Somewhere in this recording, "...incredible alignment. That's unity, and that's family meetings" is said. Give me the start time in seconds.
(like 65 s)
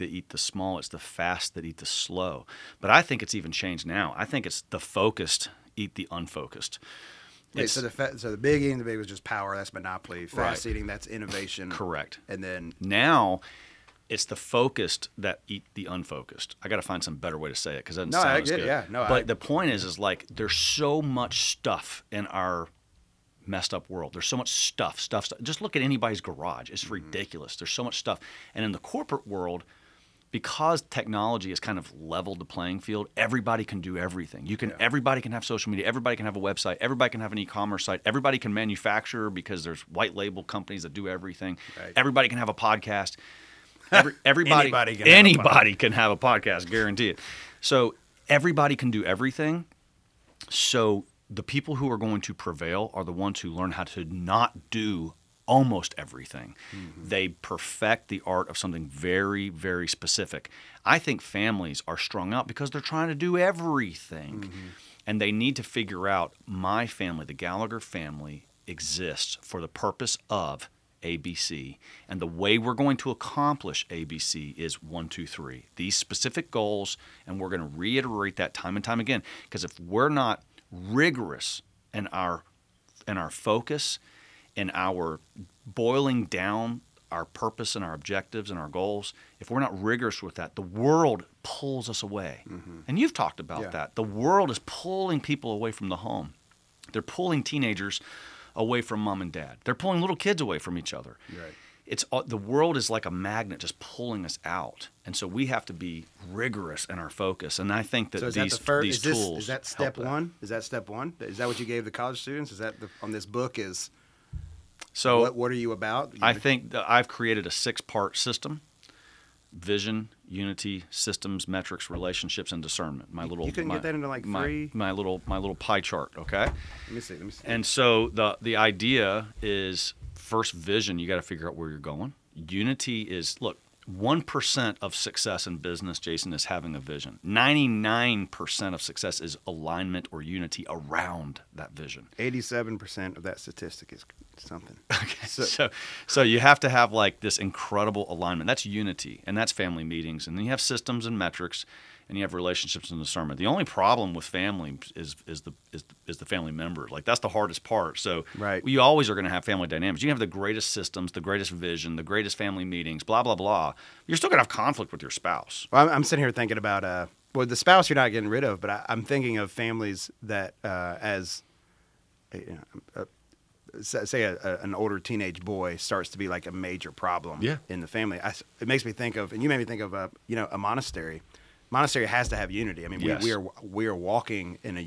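147 s.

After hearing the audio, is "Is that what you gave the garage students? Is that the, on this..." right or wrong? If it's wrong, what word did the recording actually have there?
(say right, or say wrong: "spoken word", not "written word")
wrong: "college", not "garage".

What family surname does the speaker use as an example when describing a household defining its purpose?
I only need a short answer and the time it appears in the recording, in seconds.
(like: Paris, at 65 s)
Gallagher, at 67 s.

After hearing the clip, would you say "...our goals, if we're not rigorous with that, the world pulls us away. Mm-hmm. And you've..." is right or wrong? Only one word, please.
right.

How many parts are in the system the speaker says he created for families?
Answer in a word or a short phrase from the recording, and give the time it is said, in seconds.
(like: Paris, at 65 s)
6, at 117 s.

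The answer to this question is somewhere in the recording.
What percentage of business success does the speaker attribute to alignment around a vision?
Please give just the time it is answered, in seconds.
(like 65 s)
137 s.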